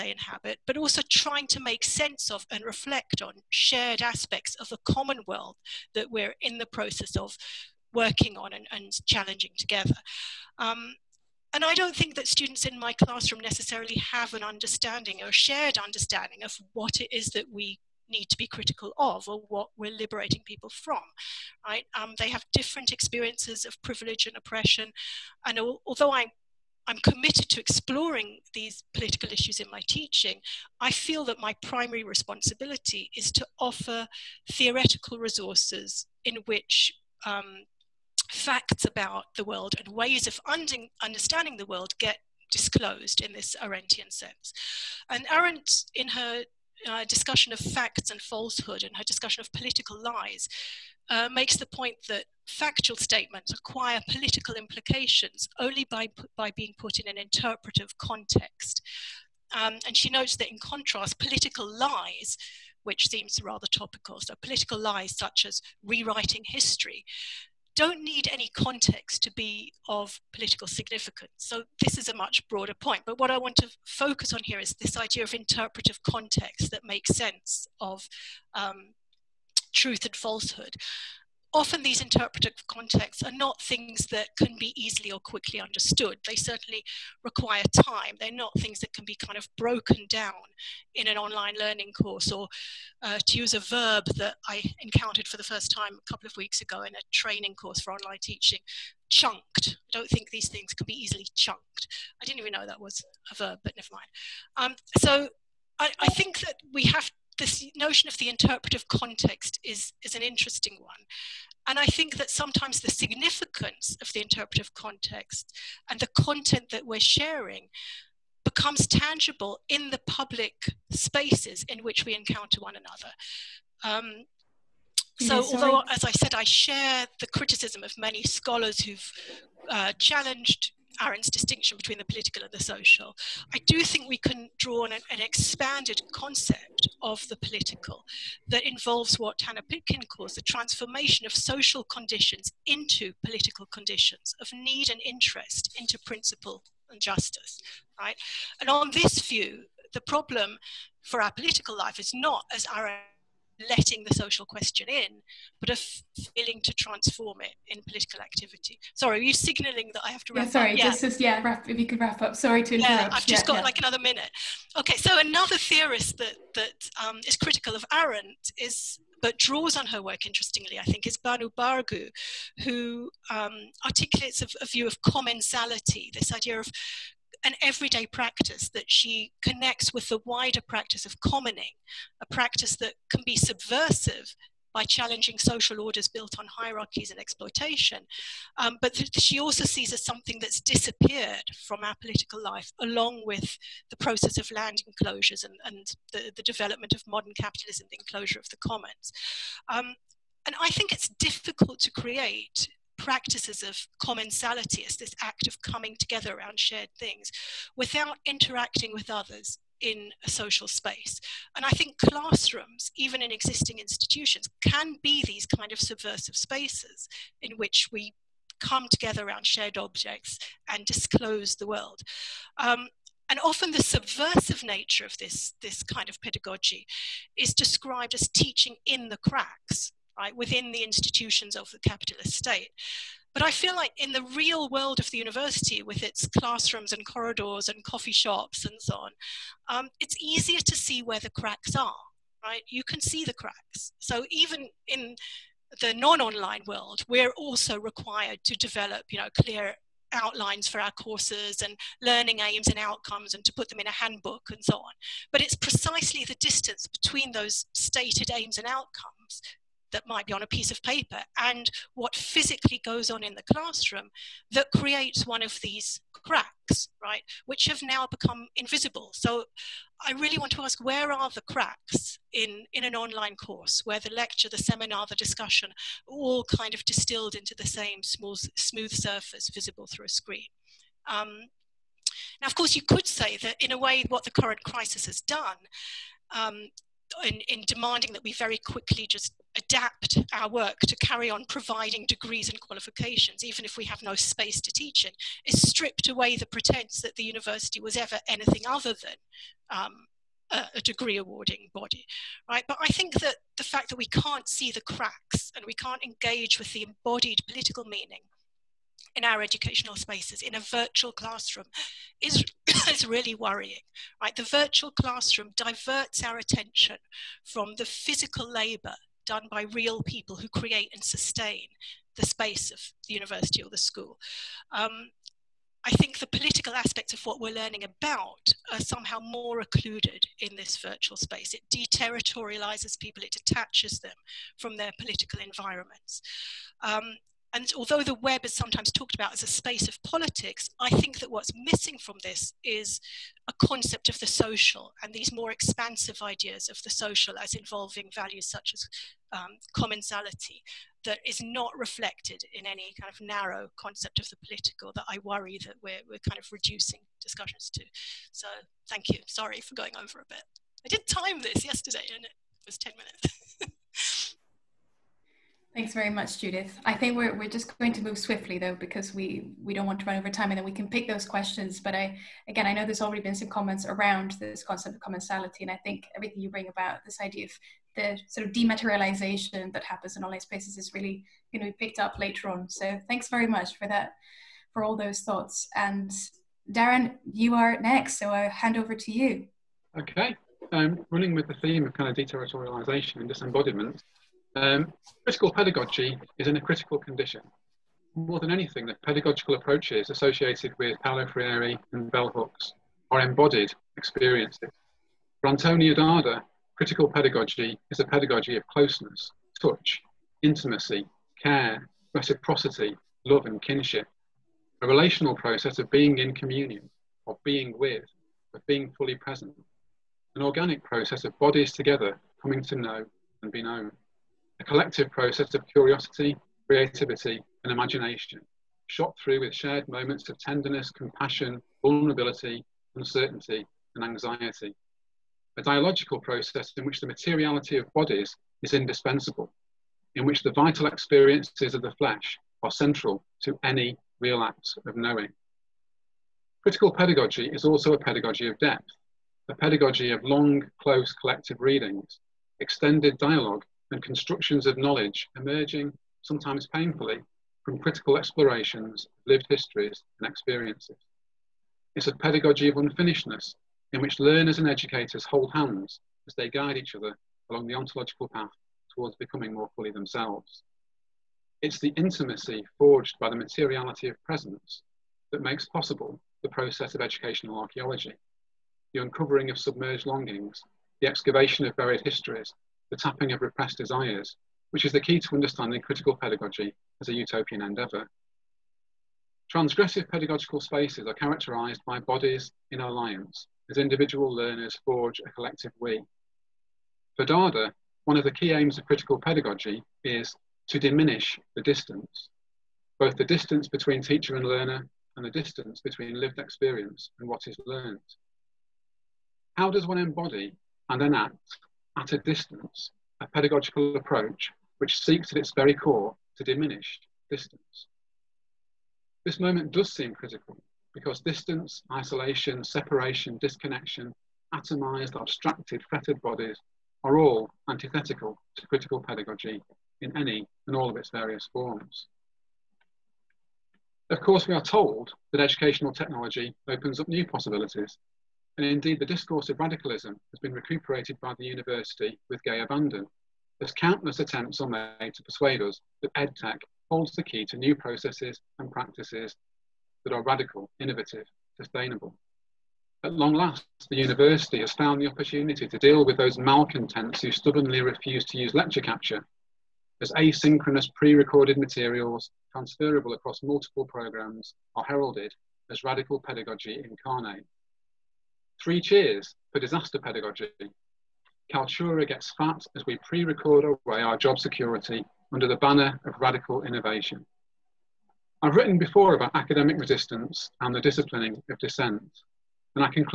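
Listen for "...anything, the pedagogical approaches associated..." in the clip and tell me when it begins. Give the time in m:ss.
6:38.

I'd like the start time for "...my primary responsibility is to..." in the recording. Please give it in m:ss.
0:31.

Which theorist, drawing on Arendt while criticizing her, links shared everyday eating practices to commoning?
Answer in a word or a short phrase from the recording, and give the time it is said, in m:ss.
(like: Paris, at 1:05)
Banu Bargu, at 2:51.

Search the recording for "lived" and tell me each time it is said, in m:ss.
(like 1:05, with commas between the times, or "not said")
7:39, 8:26.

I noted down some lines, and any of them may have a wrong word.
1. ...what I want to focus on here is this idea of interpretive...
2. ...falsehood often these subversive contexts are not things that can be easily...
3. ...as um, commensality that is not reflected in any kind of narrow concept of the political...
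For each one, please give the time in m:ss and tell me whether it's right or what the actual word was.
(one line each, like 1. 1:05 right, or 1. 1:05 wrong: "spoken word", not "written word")
1. 1:13 right
2. 1:20 wrong: "interpretive", not "subversive"
3. 5:48 right.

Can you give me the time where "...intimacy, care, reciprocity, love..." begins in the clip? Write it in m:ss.
6:50.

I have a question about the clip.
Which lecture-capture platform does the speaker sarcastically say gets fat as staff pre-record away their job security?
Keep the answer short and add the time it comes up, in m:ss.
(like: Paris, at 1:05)
Kaltura, at 9:31.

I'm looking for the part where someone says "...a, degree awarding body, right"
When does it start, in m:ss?
5:00.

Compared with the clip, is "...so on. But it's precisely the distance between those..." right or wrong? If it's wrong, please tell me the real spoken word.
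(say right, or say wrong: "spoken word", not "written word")
right.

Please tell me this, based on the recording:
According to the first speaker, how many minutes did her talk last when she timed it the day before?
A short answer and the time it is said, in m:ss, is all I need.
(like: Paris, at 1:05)
10, at 6:02.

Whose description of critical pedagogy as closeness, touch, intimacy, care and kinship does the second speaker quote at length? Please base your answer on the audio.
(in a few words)
Antonio Darder.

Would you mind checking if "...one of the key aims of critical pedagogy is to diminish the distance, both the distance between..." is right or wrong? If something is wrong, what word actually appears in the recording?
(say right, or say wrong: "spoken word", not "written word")
right.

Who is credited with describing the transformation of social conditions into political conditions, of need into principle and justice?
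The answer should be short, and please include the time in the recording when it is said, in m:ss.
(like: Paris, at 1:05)
Hanna Pitkin, at 2:19.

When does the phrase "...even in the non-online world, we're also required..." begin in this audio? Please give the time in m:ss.
4:04.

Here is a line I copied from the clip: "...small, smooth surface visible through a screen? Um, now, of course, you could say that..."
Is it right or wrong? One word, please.
right.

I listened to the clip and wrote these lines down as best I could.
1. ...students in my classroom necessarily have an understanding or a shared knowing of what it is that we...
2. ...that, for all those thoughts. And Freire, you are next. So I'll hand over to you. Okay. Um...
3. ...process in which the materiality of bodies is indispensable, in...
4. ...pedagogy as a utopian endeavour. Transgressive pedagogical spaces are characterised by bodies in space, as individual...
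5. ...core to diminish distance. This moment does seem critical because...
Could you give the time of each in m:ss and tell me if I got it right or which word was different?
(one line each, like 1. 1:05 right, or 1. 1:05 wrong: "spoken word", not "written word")
1. 0:12 wrong: "understanding", not "knowing"
2. 6:23 wrong: "Darren", not "Freire"
3. 7:16 right
4. 8:06 wrong: "alliance", not "space"
5. 8:35 right.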